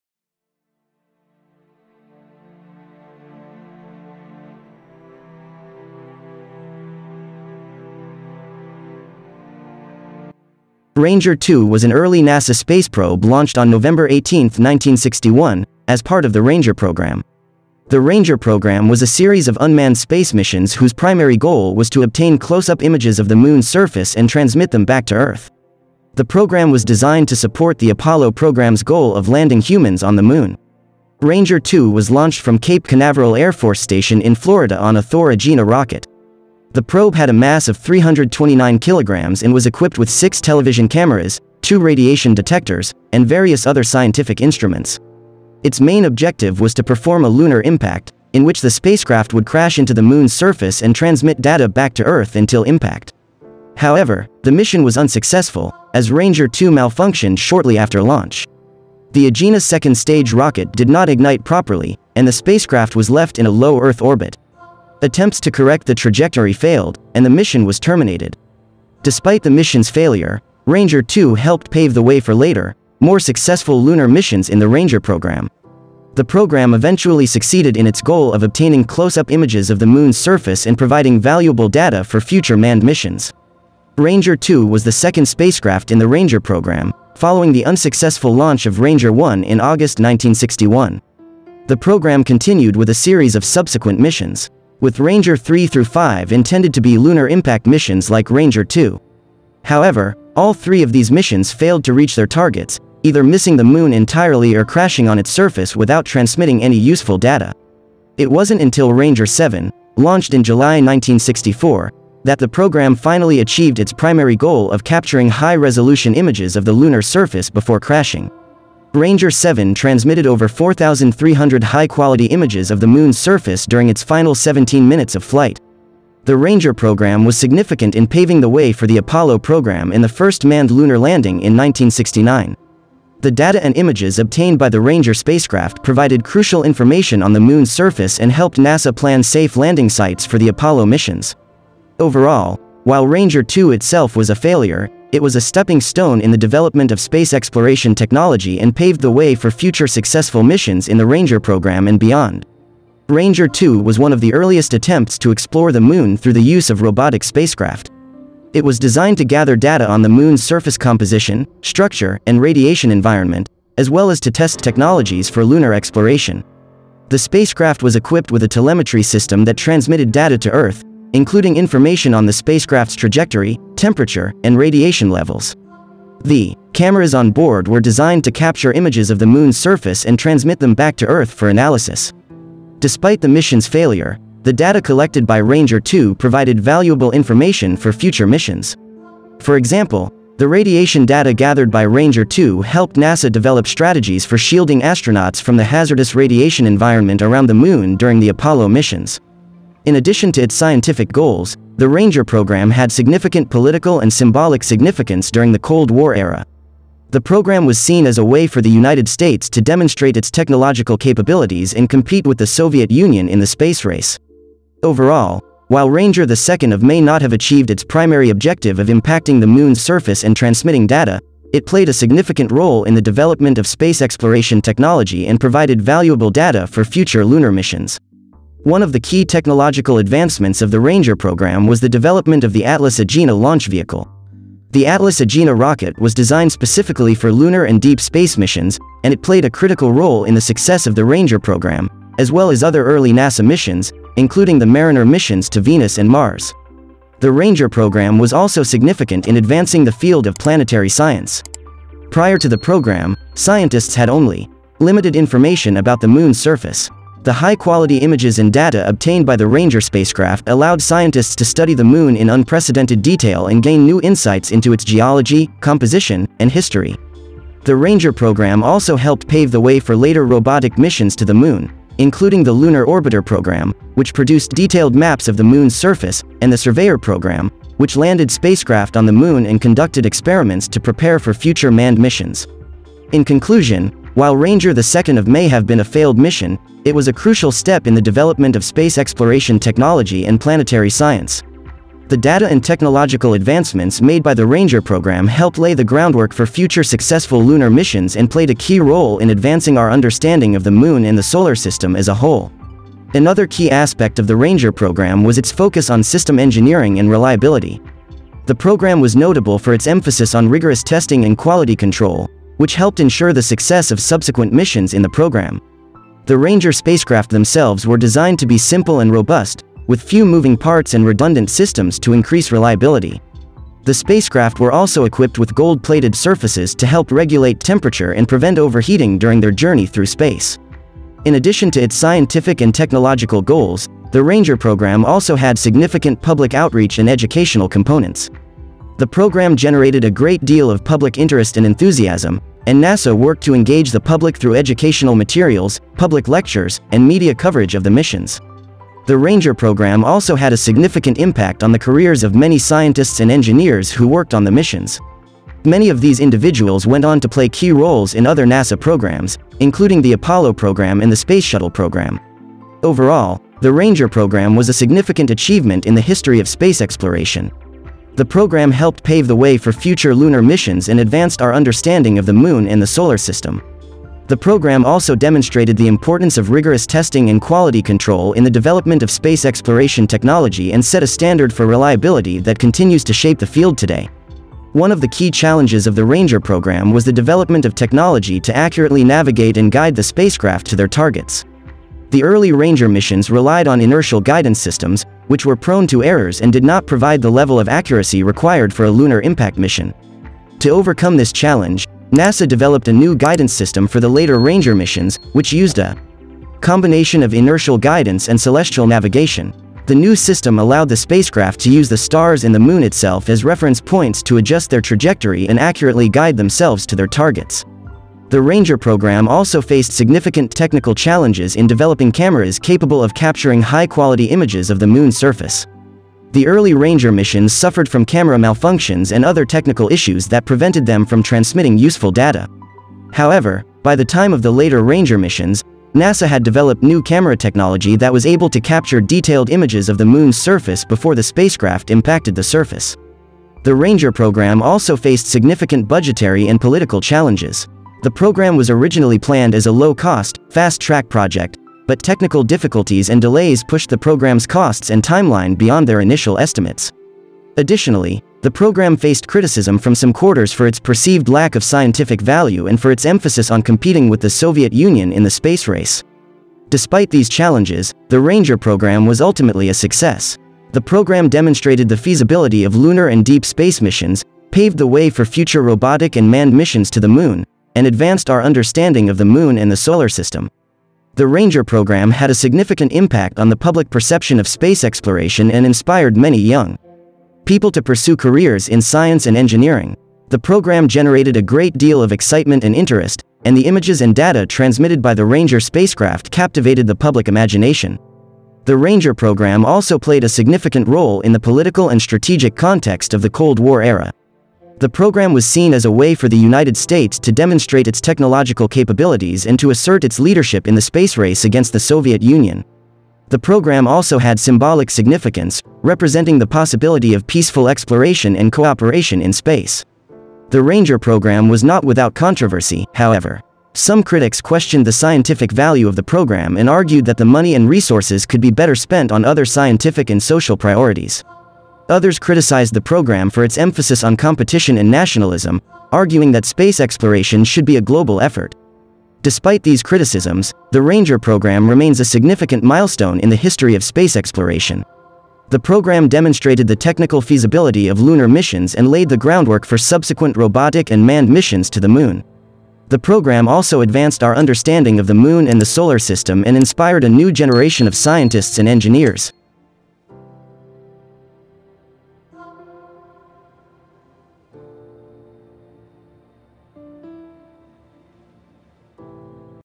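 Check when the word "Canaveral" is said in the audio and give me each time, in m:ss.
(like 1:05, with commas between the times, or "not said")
0:32.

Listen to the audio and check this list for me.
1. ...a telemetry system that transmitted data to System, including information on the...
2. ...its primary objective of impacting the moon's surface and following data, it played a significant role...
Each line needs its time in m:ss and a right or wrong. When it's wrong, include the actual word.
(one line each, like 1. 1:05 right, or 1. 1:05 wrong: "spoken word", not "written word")
1. 2:48 wrong: "Earth", not "System"
2. 3:37 wrong: "transmitting", not "following".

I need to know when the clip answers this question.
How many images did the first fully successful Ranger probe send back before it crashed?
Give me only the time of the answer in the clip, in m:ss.
2:00.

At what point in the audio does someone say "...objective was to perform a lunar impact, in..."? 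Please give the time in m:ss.
0:46.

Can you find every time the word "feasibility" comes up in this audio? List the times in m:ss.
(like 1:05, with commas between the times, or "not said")
7:51, 9:07.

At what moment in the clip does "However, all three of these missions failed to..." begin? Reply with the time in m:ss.
1:39.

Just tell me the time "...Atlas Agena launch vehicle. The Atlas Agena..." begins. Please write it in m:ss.
3:52.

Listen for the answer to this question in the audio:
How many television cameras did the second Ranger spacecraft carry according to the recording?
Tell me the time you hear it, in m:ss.
0:40.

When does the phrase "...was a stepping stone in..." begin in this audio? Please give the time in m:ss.
2:25.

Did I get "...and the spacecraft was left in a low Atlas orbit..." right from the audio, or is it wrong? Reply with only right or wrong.
wrong.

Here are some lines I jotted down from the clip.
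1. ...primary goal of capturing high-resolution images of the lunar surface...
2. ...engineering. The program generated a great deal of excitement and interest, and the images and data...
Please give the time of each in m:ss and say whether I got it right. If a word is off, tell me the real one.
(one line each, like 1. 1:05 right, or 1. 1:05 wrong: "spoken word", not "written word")
1. 1:53 right
2. 8:09 right.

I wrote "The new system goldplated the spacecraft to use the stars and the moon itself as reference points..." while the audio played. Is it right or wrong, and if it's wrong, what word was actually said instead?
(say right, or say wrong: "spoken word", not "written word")
wrong: "allowed", not "goldplated".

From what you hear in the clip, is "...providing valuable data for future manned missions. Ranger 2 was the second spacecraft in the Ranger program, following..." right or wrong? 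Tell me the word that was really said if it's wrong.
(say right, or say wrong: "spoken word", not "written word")
right.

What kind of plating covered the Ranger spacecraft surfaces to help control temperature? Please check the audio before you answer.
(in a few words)
gold-plated.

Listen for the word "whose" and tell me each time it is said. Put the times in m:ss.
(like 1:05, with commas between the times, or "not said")
0:20.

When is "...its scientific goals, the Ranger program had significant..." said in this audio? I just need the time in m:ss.
3:20.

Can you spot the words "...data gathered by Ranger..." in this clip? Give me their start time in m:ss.
3:11.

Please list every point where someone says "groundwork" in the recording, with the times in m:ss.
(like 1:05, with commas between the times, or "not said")
4:55, 9:09.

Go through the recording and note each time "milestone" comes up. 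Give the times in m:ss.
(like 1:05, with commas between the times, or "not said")
9:02.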